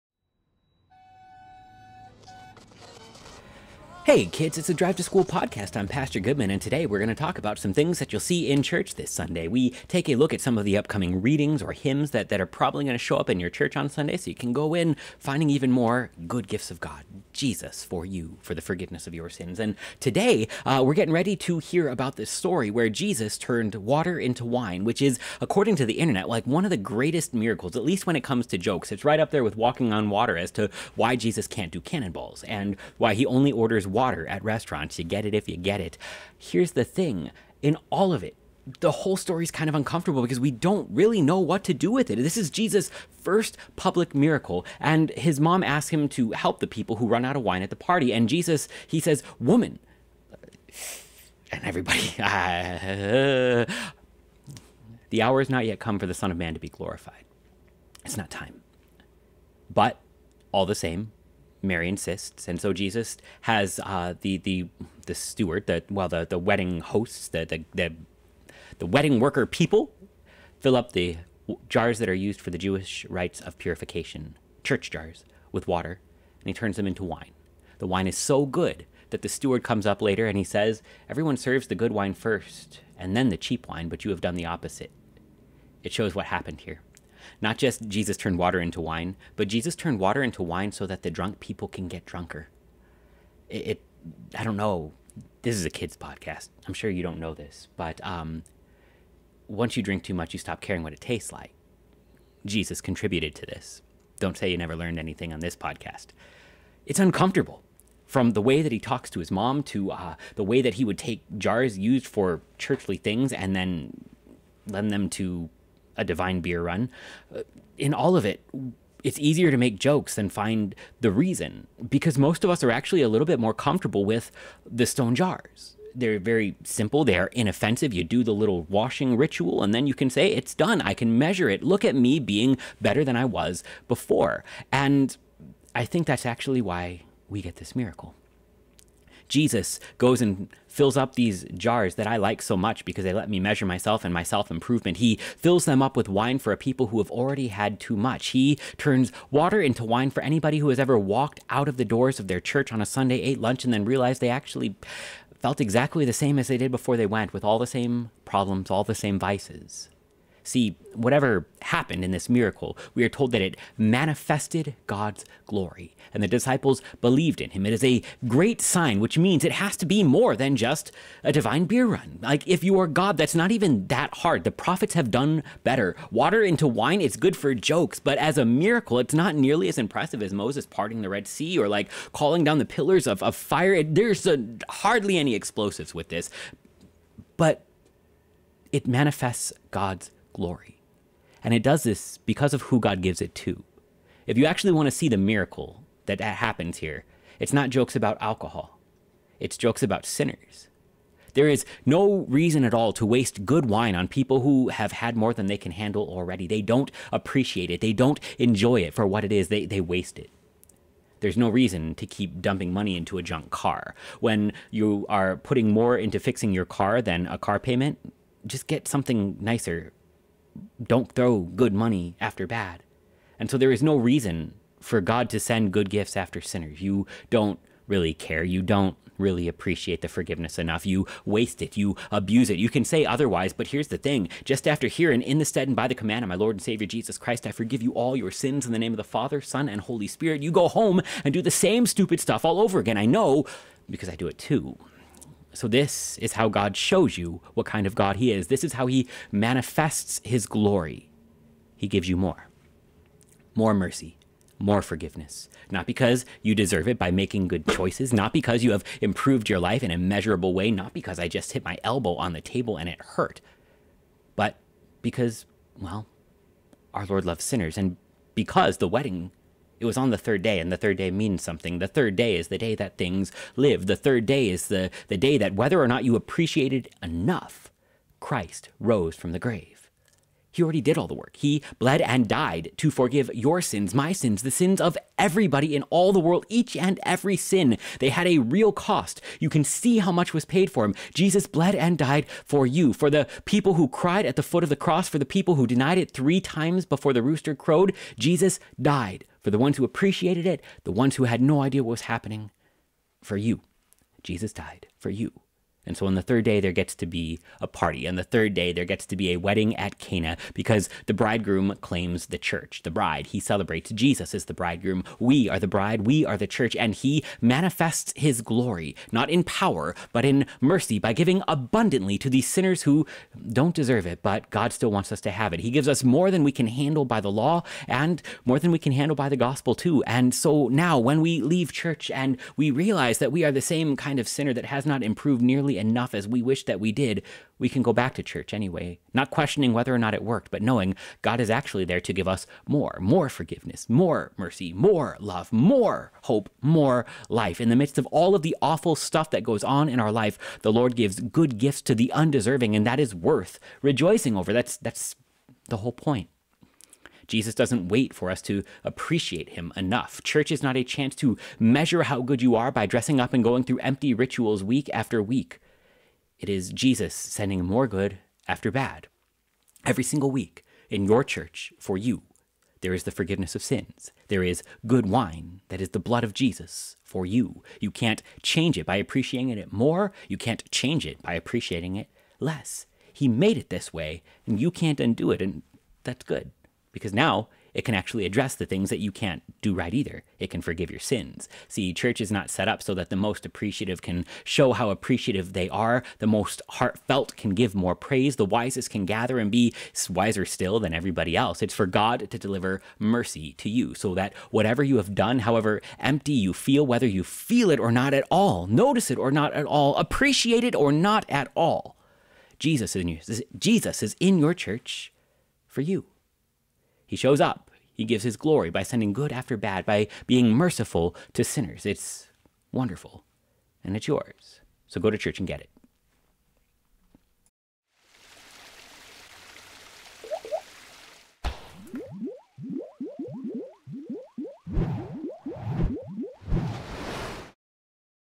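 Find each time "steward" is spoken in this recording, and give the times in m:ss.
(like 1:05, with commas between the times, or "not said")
1:05, 1:19.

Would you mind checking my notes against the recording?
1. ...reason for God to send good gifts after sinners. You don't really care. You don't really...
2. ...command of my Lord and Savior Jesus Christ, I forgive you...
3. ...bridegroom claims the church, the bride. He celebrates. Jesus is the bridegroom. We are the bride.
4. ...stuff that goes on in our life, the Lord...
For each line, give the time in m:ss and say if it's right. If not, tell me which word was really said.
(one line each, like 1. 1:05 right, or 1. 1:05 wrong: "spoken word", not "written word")
1. 3:43 right
2. 3:55 right
3. 5:11 right
4. 5:48 right.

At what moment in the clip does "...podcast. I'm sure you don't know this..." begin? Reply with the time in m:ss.
1:35.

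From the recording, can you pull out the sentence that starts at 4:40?
He already did all the work.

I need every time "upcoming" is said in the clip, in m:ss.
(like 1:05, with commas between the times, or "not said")
0:10.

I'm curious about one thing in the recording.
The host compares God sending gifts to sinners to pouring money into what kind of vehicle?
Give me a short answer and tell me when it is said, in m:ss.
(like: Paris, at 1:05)
junk car, at 3:33.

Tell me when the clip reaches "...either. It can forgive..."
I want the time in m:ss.
6:29.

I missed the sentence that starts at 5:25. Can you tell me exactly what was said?
He gives us more than we can handle by the law and more than we can handle by the gospel, too.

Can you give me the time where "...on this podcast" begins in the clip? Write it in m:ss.
1:45.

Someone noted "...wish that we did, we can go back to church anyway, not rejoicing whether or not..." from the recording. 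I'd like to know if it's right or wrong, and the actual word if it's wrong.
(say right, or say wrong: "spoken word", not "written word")
wrong: "questioning", not "rejoicing".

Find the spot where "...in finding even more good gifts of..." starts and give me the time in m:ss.
0:14.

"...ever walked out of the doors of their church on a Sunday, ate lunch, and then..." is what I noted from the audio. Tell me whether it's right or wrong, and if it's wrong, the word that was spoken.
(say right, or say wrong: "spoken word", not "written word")
right.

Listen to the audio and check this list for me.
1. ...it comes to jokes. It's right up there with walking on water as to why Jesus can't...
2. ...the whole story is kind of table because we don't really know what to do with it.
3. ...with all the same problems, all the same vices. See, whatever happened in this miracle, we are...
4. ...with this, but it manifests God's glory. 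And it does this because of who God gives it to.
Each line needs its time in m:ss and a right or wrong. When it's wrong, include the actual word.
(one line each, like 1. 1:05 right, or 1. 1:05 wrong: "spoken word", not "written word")
1. 0:28 right
2. 0:38 wrong: "uncomfortable", not "table"
3. 2:37 right
4. 3:05 right.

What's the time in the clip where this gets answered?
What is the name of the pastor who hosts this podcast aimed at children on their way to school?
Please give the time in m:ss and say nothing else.
0:05.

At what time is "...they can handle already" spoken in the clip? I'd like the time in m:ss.
3:25.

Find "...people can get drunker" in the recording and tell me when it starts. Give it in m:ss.
1:31.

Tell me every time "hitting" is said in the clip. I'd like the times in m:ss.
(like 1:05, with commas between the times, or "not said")
not said.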